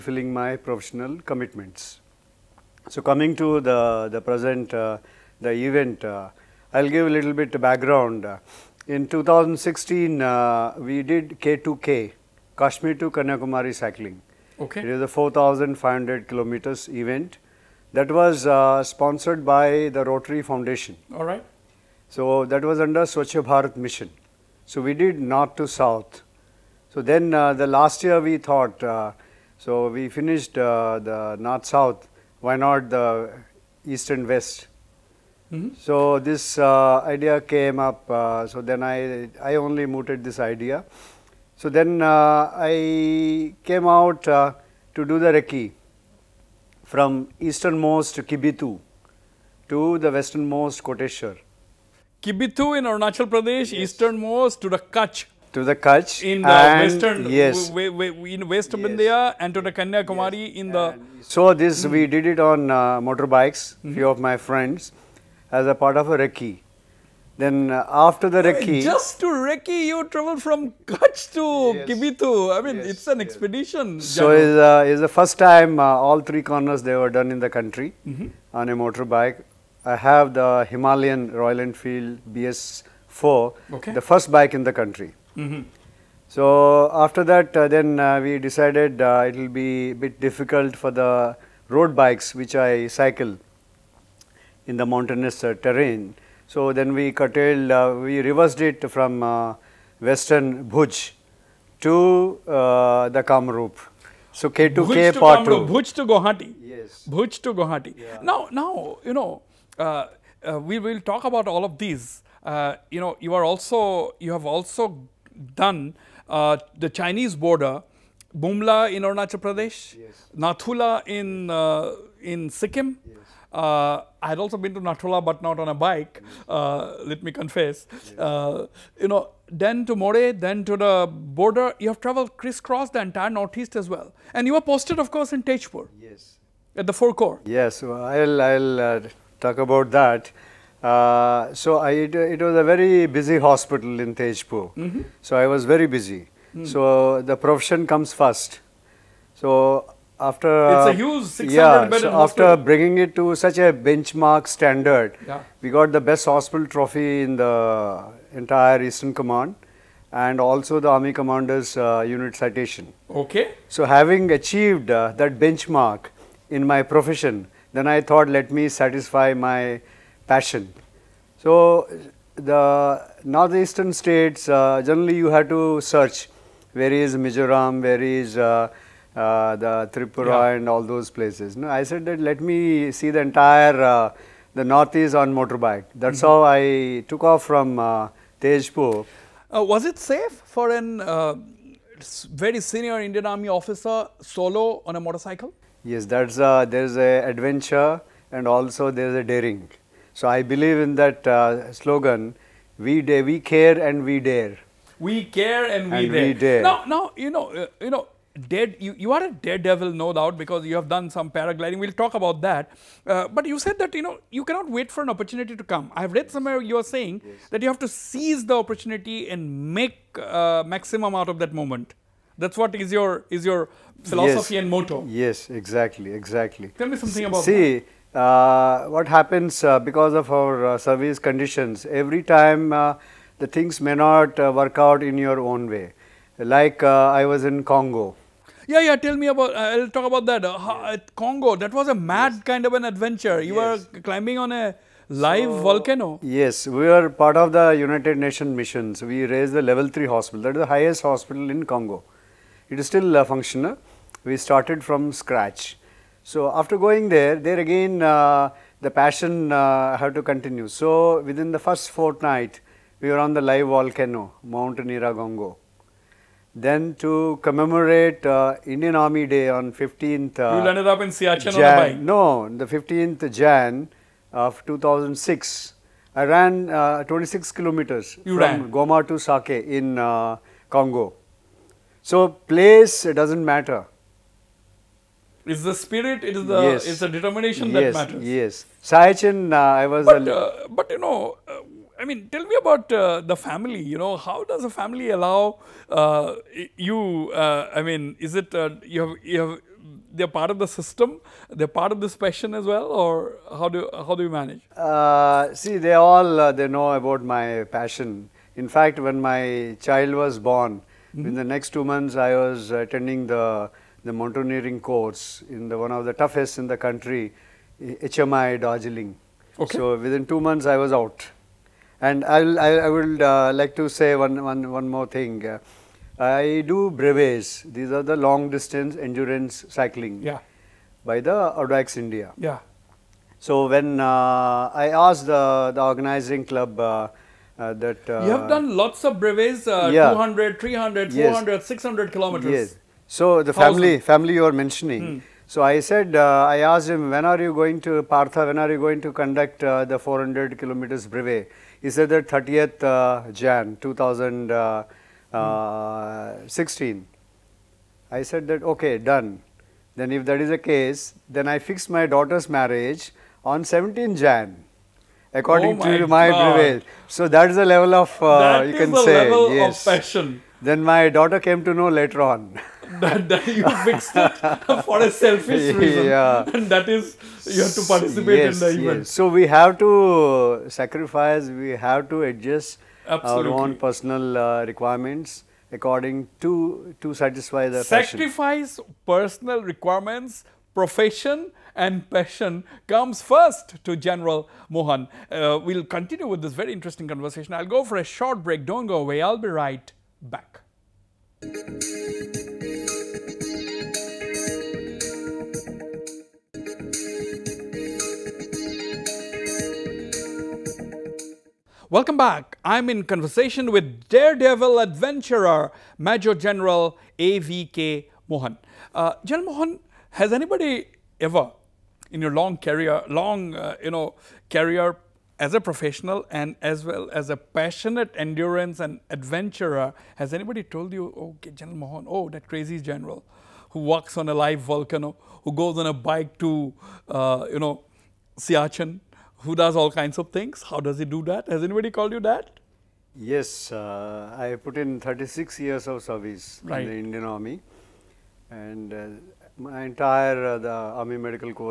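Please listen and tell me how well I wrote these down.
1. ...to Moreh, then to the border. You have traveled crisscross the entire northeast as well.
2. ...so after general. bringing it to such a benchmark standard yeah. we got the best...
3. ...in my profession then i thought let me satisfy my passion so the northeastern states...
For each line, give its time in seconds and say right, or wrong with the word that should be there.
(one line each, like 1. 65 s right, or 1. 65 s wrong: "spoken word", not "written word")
1. 129 s right
2. 152 s wrong: "hospital", not "general"
3. 166 s right.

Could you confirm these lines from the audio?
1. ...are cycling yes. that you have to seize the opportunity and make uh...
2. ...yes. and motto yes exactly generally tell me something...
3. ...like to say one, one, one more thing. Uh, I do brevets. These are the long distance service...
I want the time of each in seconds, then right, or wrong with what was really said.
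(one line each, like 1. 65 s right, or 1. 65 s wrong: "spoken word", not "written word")
1. 216 s wrong: "saying", not "cycling"
2. 224 s wrong: "exactly", not "generally"
3. 323 s wrong: "endurance", not "service".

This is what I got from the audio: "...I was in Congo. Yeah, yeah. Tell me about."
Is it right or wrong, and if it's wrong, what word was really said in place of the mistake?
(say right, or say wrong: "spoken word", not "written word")
right.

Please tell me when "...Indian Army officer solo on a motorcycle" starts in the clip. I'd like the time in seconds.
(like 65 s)
193 s.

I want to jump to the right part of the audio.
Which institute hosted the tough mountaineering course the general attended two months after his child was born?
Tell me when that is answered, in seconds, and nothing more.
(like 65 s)
318 s.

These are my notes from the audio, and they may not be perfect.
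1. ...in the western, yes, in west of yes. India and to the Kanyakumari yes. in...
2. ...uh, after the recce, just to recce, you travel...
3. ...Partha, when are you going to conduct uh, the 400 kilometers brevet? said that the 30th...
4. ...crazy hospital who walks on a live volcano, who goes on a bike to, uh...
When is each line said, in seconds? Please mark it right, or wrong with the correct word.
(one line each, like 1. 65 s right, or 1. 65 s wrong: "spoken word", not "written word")
1. 56 s right
2. 67 s right
3. 348 s right
4. 432 s wrong: "general", not "hospital".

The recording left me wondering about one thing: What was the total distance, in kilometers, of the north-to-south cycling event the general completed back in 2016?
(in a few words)
4,500 kilometers.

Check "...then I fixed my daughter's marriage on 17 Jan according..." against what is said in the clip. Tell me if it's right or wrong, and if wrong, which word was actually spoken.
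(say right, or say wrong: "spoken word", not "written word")
right.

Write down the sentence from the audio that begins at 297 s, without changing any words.
Uh, I mean, is it uh, you have you have they're part of the system?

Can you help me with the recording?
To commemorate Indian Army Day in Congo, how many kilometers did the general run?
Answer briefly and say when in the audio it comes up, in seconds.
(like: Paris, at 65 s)
26, at 277 s.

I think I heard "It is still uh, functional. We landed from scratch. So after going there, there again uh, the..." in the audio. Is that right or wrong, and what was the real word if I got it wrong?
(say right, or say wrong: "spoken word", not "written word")
wrong: "started", not "landed".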